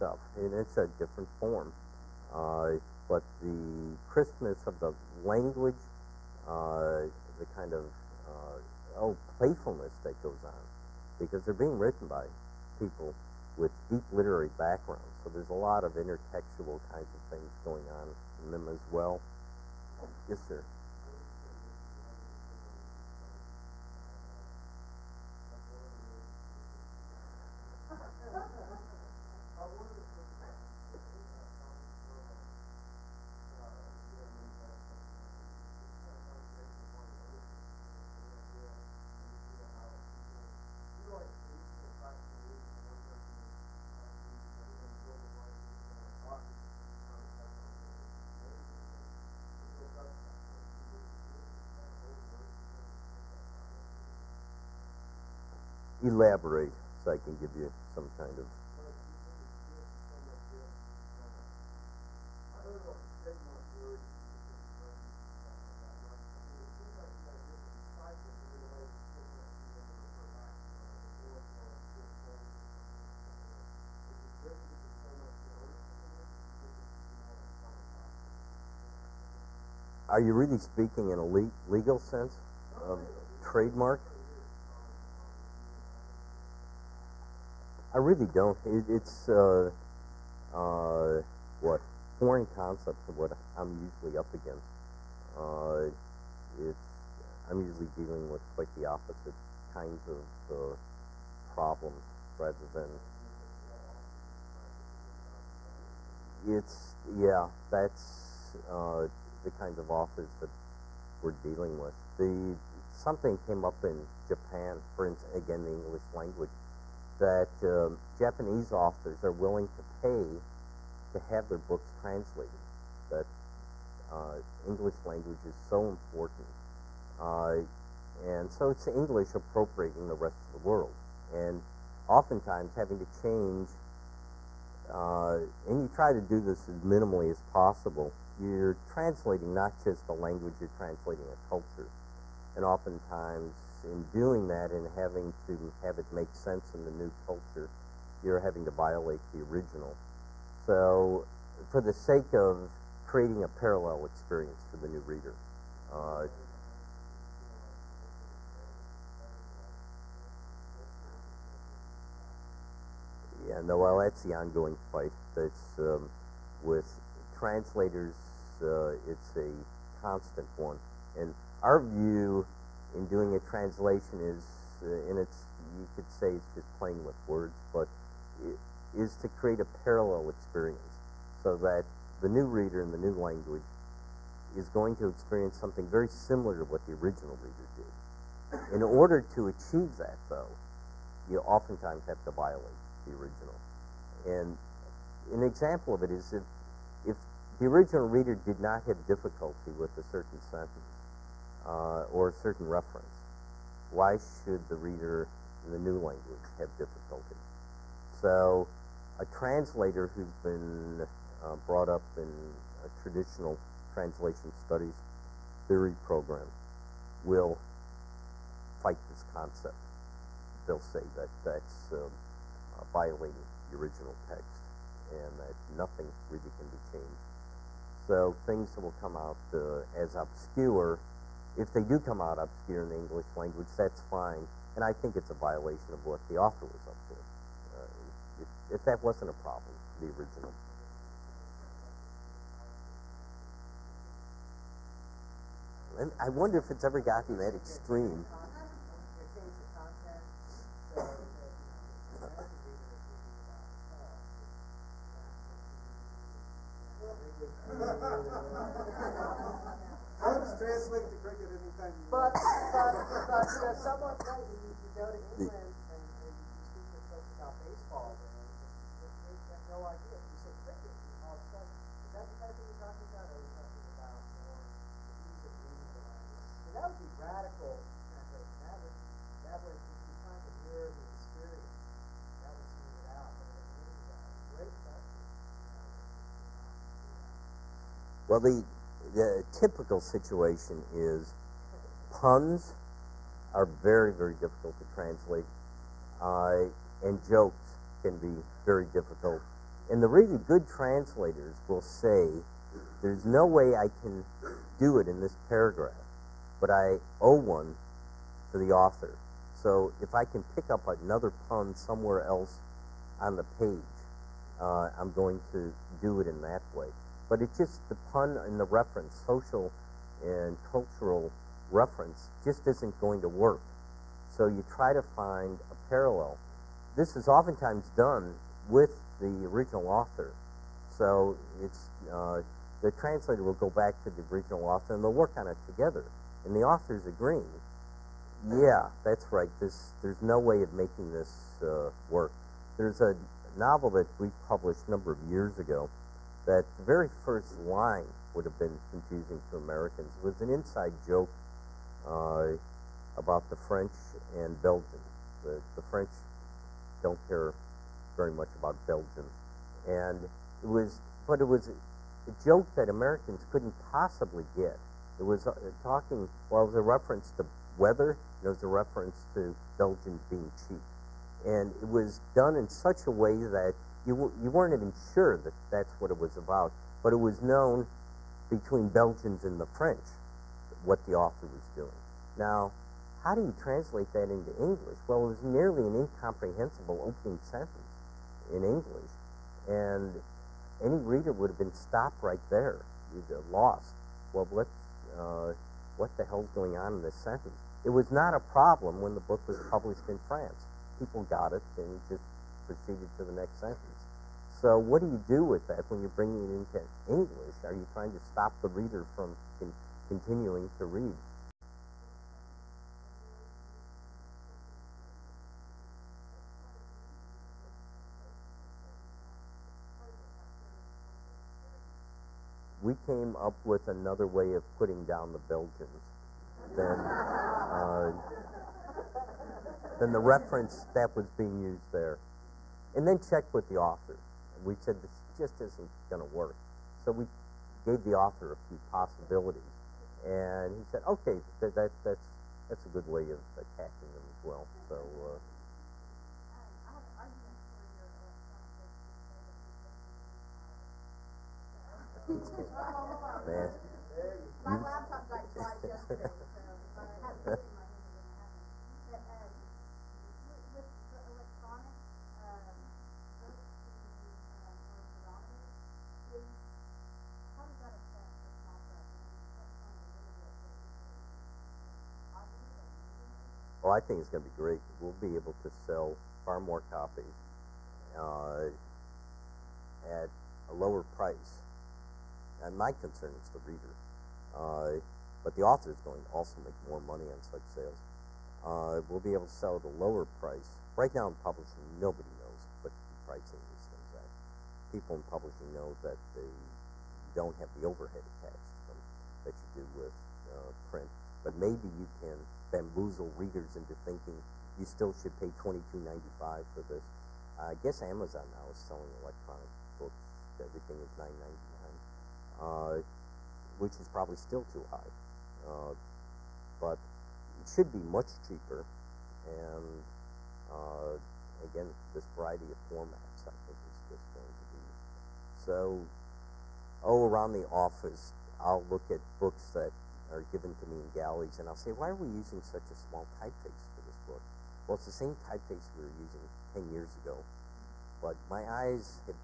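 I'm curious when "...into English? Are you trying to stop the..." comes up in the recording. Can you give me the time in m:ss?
6:46.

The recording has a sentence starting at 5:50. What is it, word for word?
It was an inside joke uh, about the French and Belgium.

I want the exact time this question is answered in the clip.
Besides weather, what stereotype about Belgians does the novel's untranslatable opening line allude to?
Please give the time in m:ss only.
6:09.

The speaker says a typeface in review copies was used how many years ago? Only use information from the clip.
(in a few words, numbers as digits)
10 years.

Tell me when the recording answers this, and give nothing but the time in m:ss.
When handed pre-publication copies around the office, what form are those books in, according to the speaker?
8:51.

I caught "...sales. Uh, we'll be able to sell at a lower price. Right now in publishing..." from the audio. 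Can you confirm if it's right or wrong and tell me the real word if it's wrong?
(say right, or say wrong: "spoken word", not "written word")
right.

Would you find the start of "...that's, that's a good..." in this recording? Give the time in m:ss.
7:22.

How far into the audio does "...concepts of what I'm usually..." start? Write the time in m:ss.
1:32.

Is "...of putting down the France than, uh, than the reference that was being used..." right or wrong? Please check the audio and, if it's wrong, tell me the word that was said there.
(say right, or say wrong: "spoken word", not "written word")
wrong: "Belgians", not "France".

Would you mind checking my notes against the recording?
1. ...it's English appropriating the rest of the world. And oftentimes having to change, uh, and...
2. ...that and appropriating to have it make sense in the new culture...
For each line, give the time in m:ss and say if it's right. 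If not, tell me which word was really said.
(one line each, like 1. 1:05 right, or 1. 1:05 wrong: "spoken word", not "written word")
1. 2:08 right
2. 2:24 wrong: "having", not "appropriating".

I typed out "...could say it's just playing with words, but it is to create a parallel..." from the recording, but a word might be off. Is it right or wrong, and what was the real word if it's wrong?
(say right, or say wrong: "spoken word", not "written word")
right.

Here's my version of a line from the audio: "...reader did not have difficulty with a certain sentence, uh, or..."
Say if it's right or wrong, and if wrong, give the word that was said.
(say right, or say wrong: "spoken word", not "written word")
right.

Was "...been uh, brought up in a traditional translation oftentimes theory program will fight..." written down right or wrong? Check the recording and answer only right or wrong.
wrong.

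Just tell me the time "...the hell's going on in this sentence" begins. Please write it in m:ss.
6:36.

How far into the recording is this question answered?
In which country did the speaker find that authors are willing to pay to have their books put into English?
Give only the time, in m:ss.
1:54.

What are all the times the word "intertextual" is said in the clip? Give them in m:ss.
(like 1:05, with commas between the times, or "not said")
0:15.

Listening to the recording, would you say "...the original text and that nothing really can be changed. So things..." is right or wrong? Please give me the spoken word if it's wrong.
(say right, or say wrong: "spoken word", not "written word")
right.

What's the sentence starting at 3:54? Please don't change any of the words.
And I think it's a violation of what the author was up to.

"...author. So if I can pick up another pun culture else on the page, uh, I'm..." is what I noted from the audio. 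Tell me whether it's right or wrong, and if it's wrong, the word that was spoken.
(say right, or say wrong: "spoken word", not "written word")
wrong: "somewhere", not "culture".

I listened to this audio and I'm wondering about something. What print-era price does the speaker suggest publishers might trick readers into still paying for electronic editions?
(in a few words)
$22.95.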